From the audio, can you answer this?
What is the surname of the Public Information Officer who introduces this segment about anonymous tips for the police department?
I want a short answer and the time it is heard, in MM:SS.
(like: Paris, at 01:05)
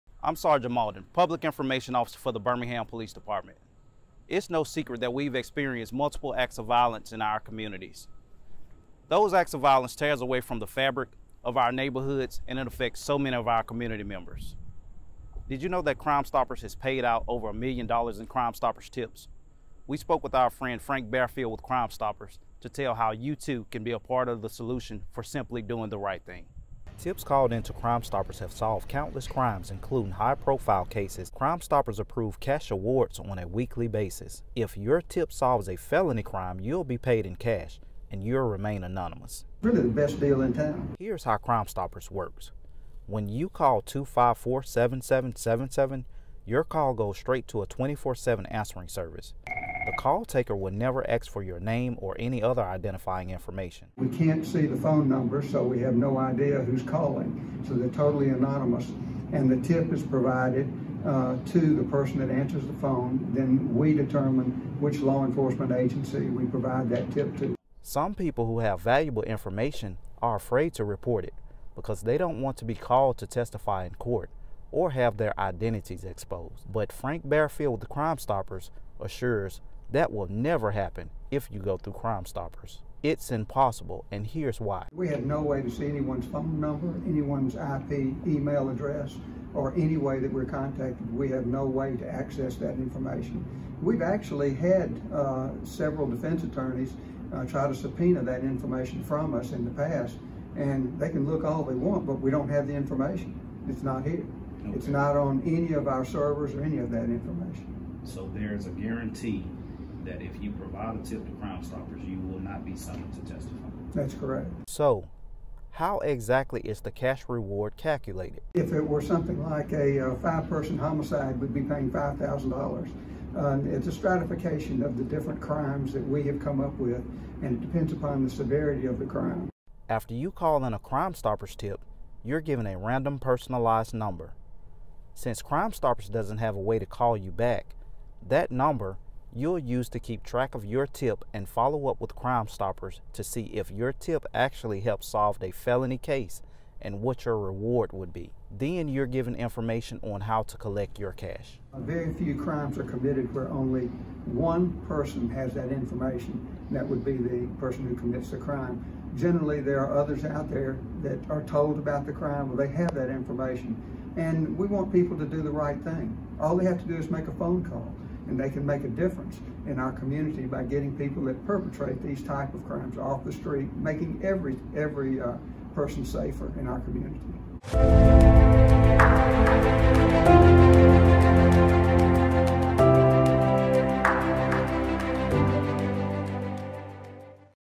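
Mauldin, at 00:00.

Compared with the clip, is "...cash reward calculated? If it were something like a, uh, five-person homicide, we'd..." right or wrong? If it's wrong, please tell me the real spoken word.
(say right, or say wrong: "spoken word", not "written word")
right.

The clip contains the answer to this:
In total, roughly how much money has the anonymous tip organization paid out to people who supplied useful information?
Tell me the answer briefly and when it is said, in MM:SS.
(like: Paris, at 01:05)
over a million dollars, at 00:17.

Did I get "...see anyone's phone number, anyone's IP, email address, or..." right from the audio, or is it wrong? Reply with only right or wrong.
right.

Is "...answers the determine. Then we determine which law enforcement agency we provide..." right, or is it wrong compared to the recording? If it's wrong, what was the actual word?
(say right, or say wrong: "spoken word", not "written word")
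wrong: "phone", not "determine".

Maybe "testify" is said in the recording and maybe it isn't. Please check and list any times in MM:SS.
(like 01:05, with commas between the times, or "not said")
01:13, 01:53.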